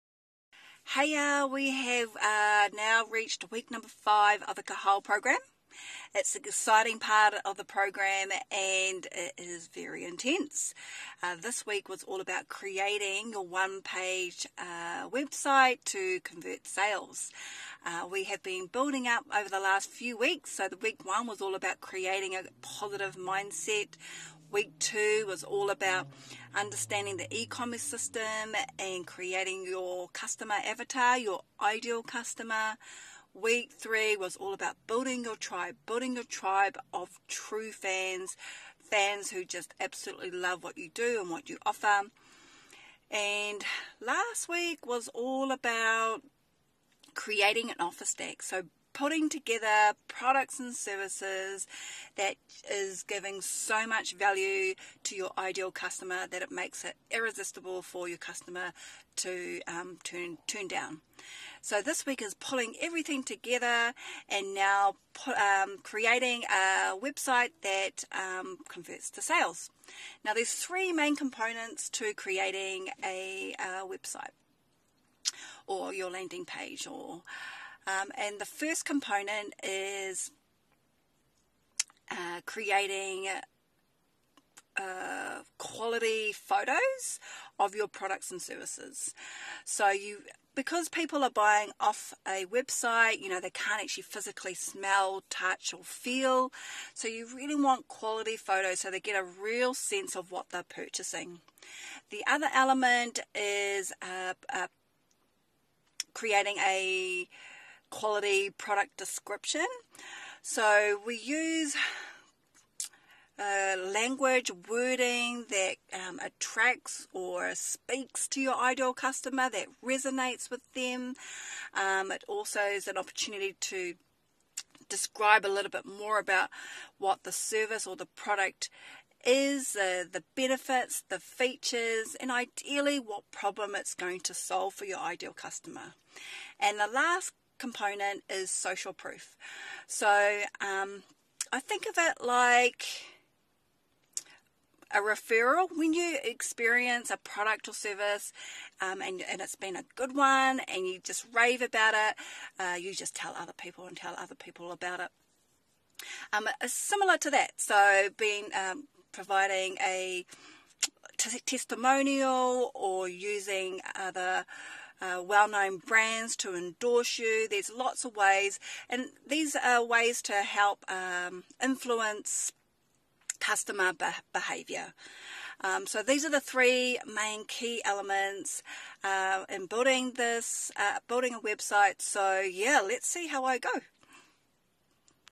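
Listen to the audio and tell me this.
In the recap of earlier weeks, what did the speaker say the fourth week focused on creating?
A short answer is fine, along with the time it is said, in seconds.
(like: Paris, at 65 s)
An office deck, at 47 s.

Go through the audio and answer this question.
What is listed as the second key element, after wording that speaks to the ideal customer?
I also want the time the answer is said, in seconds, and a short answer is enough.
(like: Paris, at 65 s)
Quality product description, at 107 s.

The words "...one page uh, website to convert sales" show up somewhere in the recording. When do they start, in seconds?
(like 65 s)
13 s.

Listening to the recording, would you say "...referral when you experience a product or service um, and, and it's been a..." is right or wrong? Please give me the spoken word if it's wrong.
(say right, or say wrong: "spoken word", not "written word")
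right.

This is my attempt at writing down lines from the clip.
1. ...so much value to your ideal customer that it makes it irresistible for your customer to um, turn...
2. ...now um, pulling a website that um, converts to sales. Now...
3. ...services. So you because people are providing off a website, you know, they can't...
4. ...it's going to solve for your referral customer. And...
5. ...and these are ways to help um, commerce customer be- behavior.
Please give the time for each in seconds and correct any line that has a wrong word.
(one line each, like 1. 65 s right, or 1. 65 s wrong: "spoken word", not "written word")
1. 53 s right
2. 64 s wrong: "creating", not "pulling"
3. 88 s wrong: "buying", not "providing"
4. 133 s wrong: "ideal", not "referral"
5. 168 s wrong: "influence", not "commerce".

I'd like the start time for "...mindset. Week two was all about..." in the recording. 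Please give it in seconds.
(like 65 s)
23 s.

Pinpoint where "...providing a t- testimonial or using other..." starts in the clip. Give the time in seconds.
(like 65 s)
159 s.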